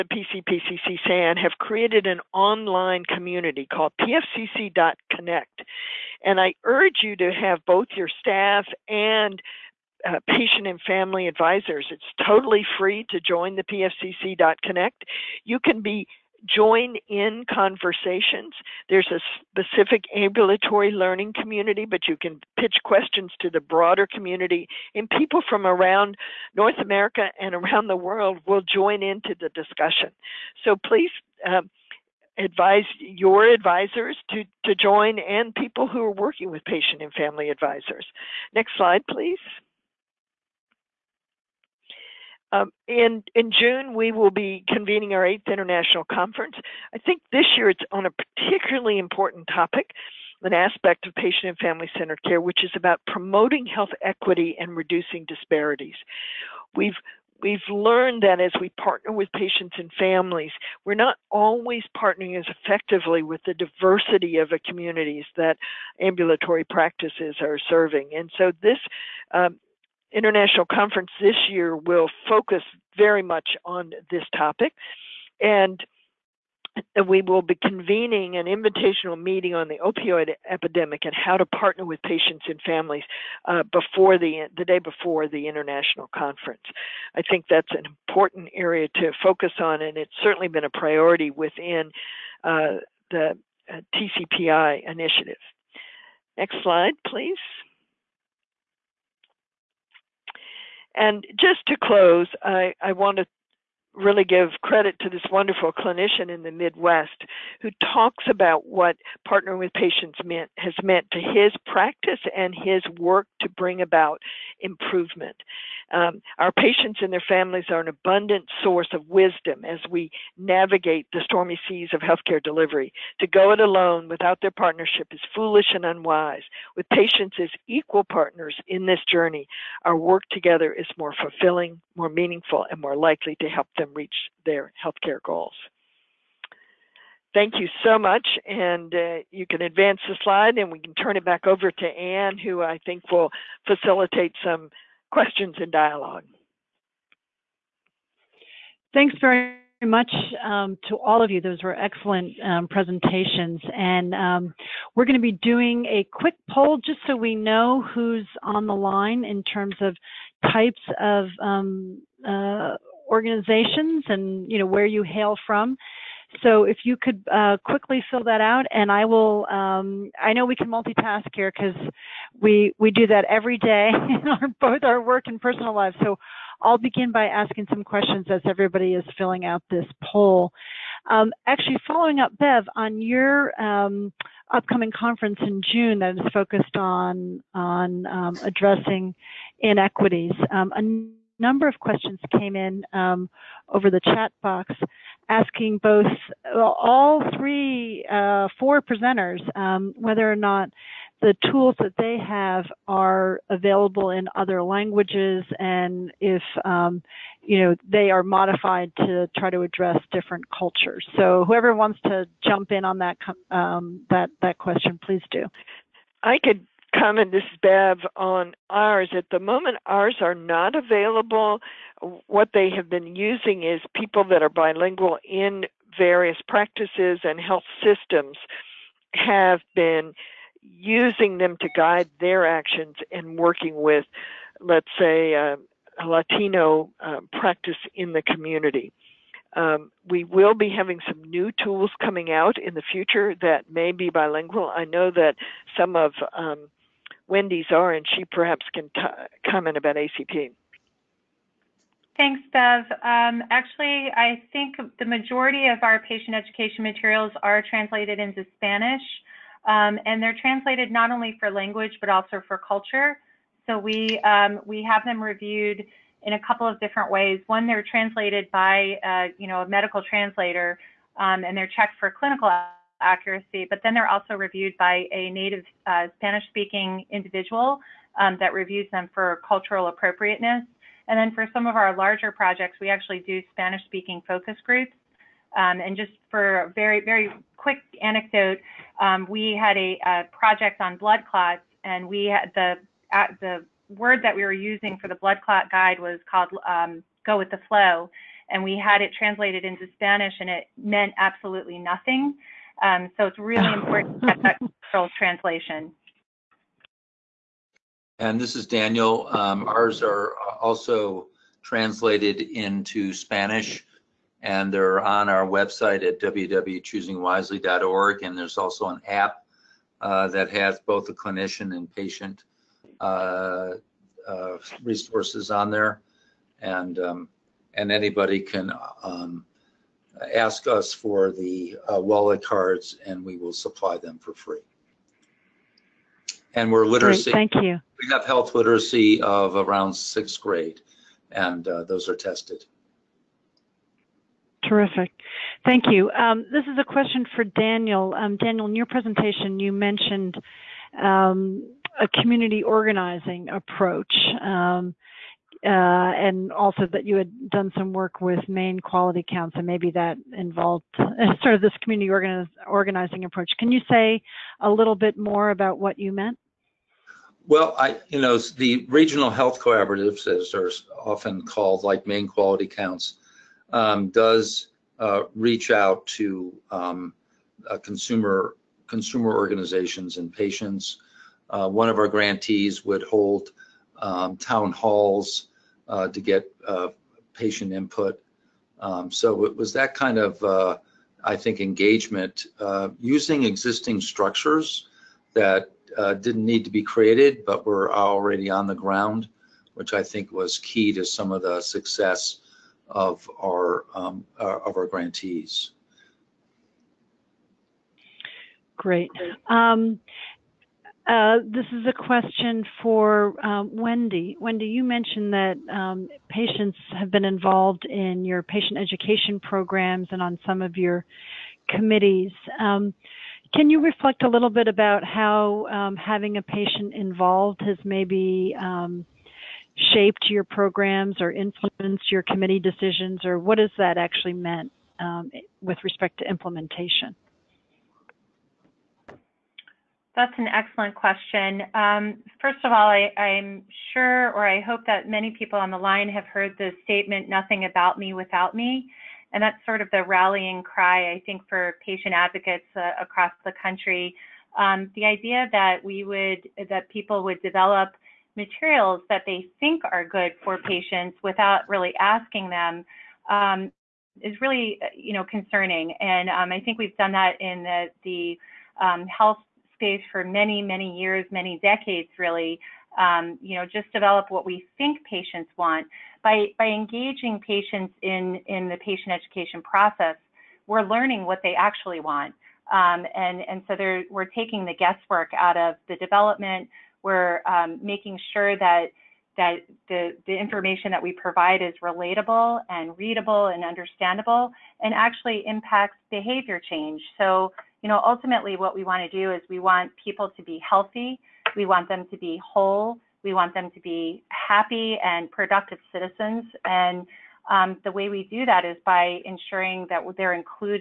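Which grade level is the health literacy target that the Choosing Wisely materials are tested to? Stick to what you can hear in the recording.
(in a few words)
6th grade.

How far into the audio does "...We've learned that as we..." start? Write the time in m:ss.
0:57.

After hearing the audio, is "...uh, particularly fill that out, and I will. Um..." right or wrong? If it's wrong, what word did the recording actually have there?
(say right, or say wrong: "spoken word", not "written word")
wrong: "quickly", not "particularly".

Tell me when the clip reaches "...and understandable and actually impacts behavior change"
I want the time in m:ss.
8:13.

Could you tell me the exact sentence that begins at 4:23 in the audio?
So we um, we have them reviewed in a couple of different ways.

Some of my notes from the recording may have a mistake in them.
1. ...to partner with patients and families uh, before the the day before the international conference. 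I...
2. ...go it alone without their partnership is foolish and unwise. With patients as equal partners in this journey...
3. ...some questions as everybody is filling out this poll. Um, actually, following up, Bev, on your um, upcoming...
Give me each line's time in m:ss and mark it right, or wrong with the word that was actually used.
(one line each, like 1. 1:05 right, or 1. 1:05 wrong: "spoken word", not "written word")
1. 1:21 right
2. 2:03 right
3. 2:57 right.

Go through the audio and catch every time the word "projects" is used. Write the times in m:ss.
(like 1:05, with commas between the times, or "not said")
4:42, 4:50.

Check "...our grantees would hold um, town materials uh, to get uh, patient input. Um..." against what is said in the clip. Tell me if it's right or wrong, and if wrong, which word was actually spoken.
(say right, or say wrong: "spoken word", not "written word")
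wrong: "halls", not "materials".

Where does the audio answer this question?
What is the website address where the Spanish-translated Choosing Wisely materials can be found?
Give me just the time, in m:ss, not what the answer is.
5:16.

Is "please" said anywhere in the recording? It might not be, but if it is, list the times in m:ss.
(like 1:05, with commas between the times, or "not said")
0:30, 0:39, 1:37, 3:35.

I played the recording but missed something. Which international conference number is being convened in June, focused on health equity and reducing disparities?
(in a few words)
8th.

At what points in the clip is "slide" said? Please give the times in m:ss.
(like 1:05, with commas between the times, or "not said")
0:38, 1:36, 2:20.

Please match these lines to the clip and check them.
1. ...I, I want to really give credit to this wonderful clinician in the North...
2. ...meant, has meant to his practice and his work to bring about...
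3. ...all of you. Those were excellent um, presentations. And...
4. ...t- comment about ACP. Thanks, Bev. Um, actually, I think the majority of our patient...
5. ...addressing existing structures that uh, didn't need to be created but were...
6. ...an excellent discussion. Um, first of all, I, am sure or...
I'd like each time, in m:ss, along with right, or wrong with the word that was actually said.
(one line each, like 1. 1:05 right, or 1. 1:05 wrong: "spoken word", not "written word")
1. 1:42 wrong: "Midwest", not "North"
2. 1:50 right
3. 2:30 right
4. 4:08 right
5. 6:32 wrong: "using", not "addressing"
6. 7:20 wrong: "question", not "discussion".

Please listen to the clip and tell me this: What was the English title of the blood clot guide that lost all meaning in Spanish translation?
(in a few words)
Go with the flow.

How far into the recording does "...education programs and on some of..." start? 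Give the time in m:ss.
6:58.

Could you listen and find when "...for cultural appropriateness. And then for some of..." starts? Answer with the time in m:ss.
4:39.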